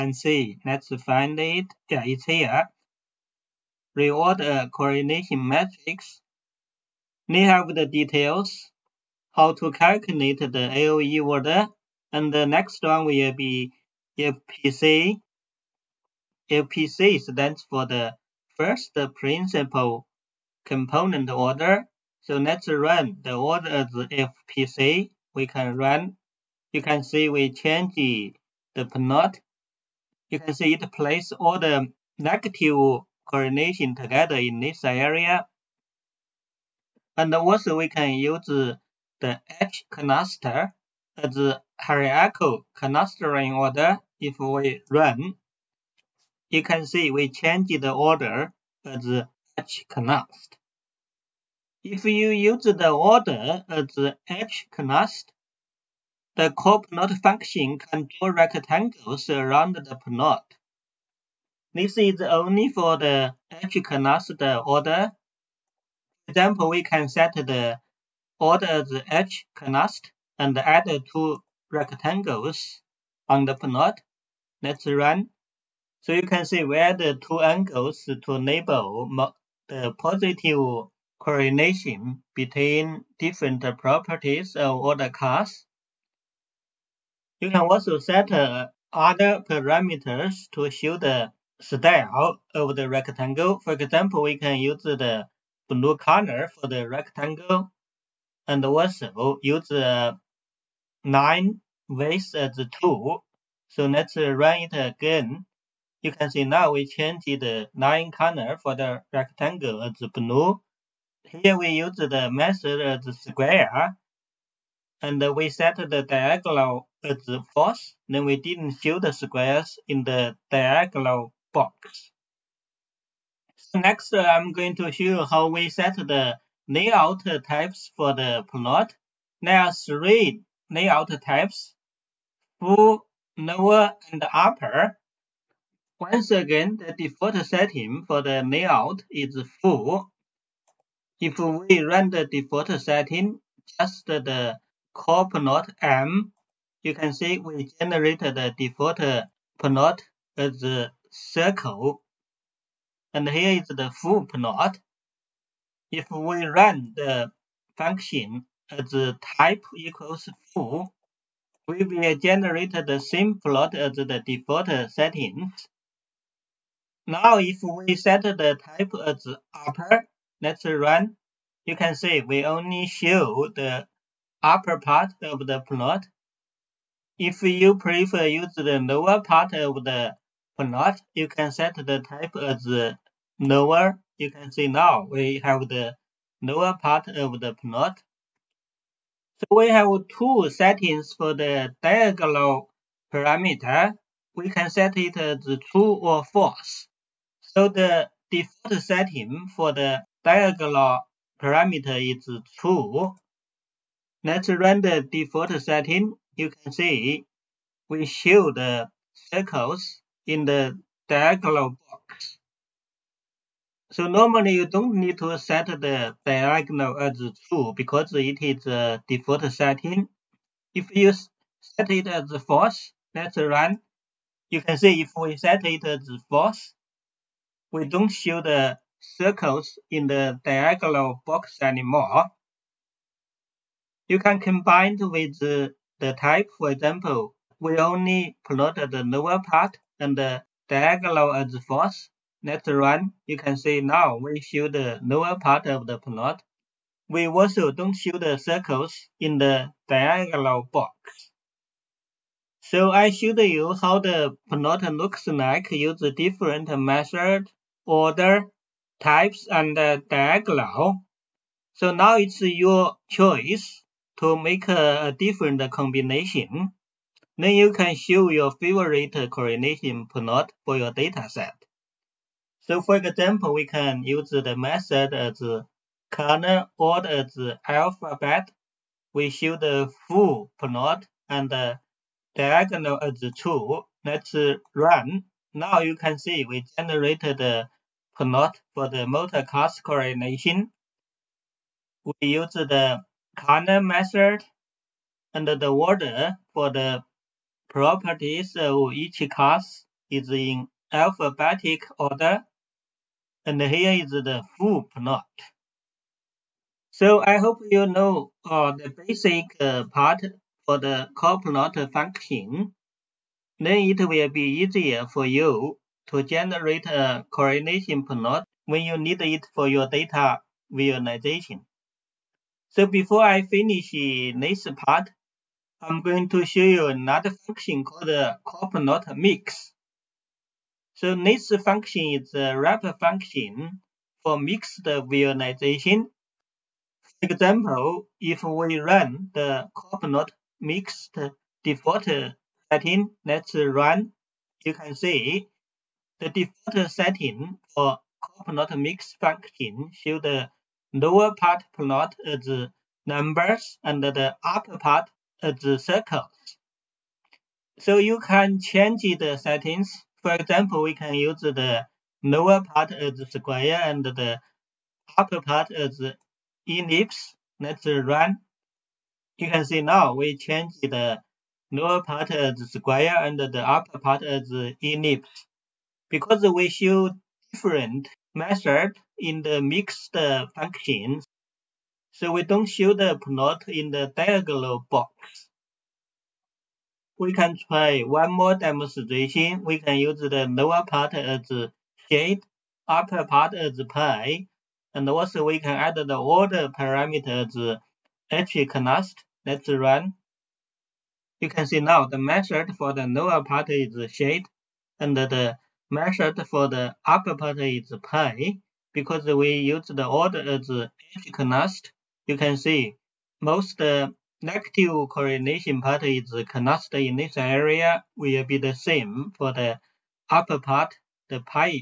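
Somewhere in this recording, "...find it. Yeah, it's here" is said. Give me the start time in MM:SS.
00:01.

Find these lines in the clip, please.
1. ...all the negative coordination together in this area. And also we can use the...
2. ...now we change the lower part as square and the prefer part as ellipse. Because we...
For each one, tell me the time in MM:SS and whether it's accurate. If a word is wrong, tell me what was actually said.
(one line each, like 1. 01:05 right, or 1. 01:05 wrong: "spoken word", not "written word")
1. 00:31 right
2. 06:09 wrong: "upper", not "prefer".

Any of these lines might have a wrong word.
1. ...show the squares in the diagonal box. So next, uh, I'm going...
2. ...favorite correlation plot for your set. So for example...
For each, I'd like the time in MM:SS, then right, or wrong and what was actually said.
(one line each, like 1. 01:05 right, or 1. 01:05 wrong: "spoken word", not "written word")
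1. 01:58 right
2. 04:28 right.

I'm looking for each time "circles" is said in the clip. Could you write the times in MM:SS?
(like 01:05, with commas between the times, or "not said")
02:31, 03:29, 03:49, 04:08, 05:55.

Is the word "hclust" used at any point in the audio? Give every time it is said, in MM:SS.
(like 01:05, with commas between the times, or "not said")
01:03, 01:09, 06:38, 06:51.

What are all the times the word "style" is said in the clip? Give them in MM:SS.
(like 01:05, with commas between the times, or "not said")
01:31.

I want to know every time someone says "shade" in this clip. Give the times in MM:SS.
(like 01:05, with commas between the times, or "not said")
06:32, 06:44.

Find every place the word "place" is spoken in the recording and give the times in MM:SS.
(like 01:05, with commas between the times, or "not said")
00:30.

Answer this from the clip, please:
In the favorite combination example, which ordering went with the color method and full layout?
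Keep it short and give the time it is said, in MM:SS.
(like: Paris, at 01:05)
alphabet, at 04:37.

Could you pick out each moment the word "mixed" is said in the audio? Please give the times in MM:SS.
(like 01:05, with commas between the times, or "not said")
05:34, 05:40, 06:19.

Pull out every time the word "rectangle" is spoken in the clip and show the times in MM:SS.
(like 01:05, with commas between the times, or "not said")
00:58, 01:11, 01:32, 01:36, 01:49.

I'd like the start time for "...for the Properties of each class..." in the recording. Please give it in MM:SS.
04:56.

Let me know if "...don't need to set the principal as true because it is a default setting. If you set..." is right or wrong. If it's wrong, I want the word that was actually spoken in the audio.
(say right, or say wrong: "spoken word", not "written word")
wrong: "diagonal", not "principal".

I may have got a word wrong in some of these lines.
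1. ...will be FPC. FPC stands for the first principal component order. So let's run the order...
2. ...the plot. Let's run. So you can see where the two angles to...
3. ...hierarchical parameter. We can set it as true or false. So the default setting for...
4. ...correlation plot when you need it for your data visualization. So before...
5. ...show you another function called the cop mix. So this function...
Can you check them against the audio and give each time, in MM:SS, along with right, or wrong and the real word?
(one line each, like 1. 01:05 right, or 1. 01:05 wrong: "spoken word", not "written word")
1. 00:13 right
2. 01:13 right
3. 03:11 wrong: "diagonal", not "hierarchical"
4. 05:17 right
5. 05:26 right.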